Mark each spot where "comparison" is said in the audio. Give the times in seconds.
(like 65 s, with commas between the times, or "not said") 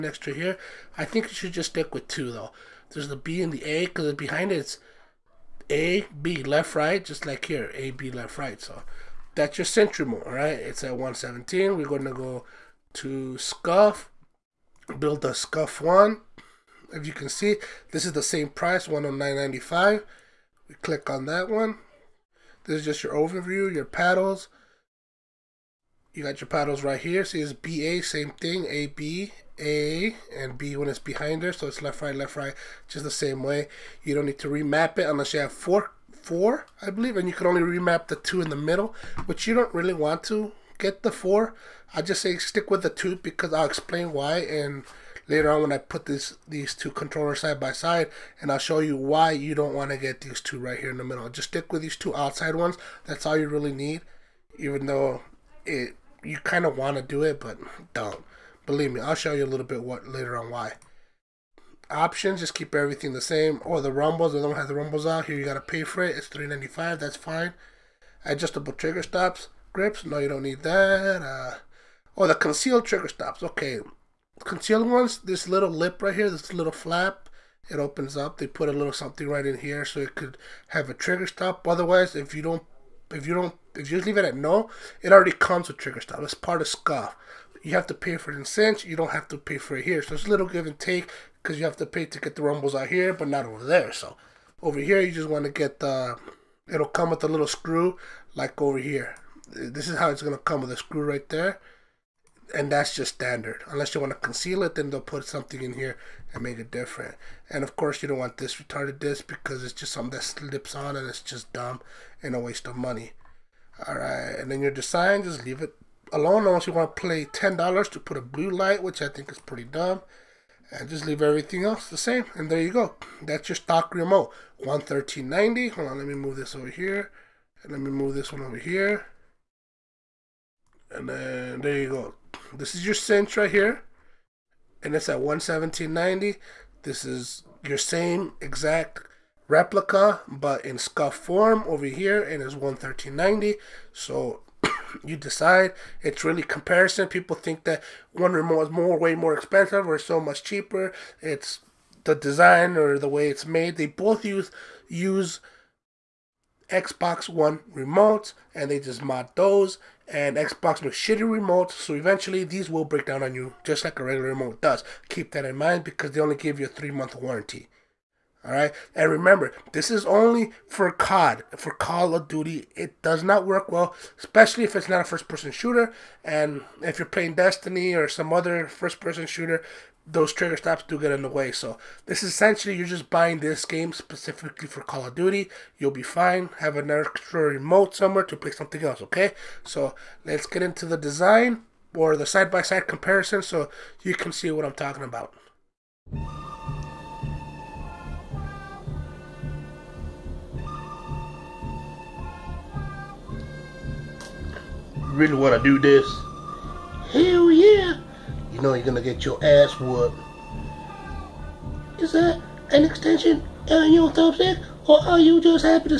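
146 s, 192 s.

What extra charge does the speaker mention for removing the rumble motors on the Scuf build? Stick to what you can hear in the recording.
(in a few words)
$3.95.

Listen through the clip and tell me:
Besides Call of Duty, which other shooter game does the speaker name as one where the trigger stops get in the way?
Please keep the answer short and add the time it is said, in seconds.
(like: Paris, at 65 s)
Destiny, at 177 s.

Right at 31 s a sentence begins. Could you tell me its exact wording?
So it's left, right, left, right, just the same way.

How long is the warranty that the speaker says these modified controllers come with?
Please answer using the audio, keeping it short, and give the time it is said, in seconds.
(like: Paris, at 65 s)
3 months, at 166 s.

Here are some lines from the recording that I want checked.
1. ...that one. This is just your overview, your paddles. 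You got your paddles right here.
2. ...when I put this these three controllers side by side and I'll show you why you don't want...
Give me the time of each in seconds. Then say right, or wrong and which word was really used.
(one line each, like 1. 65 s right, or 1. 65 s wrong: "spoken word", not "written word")
1. 21 s right
2. 45 s wrong: "two", not "three".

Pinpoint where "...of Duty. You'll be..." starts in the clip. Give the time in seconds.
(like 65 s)
185 s.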